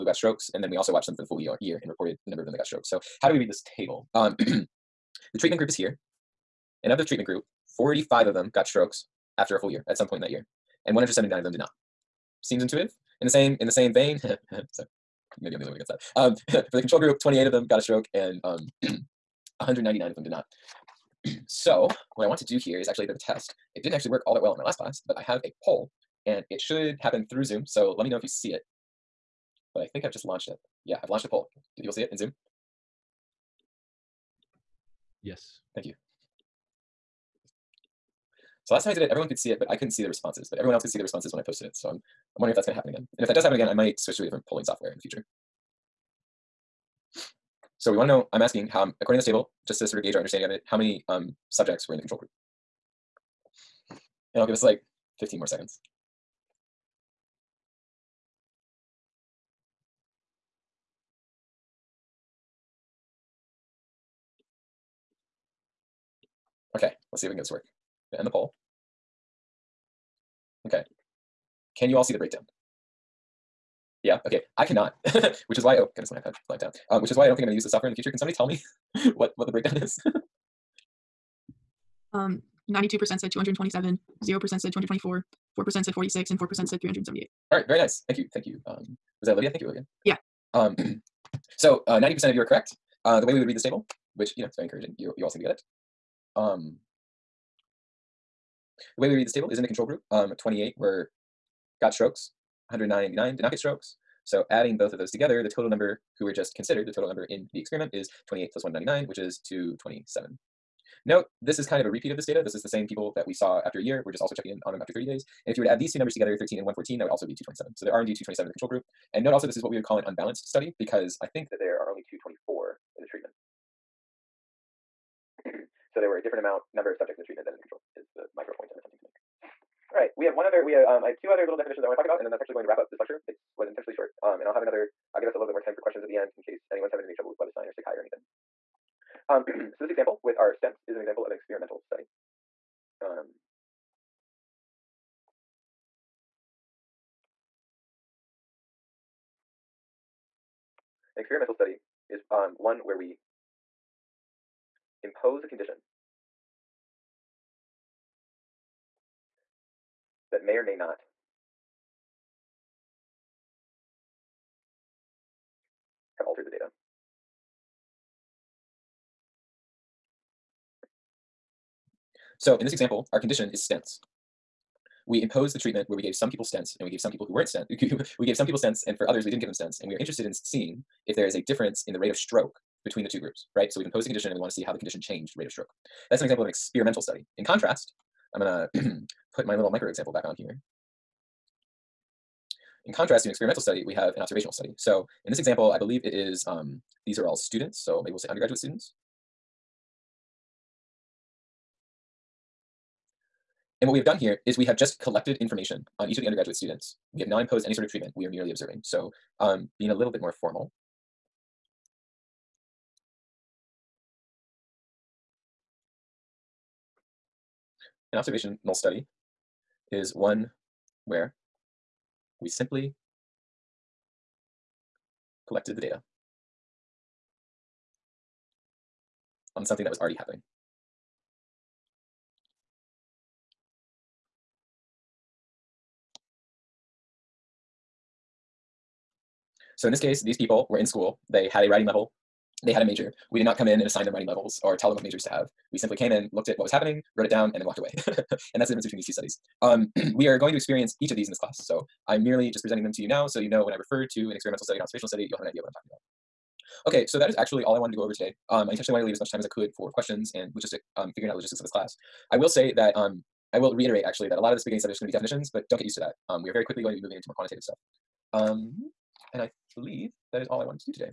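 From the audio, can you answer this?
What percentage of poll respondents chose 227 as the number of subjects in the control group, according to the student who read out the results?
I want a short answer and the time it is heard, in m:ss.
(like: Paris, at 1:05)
92%, at 1:22.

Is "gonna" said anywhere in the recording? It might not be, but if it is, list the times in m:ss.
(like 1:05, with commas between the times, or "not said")
0:42, 1:17, 3:08.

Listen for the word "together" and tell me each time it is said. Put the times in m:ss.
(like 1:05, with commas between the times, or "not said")
1:45, 1:56.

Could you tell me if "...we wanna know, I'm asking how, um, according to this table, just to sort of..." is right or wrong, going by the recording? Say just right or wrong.
right.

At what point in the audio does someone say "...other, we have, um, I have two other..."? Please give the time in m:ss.
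2:10.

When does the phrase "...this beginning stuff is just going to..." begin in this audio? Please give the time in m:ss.
4:24.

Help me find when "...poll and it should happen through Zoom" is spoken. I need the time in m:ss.
0:25.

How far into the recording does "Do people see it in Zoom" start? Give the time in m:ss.
0:31.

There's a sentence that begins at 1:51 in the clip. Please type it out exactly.
Note this is kind of a repeat of this data.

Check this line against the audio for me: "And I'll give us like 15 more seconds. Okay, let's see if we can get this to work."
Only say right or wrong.
right.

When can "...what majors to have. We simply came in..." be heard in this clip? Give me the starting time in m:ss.
4:04.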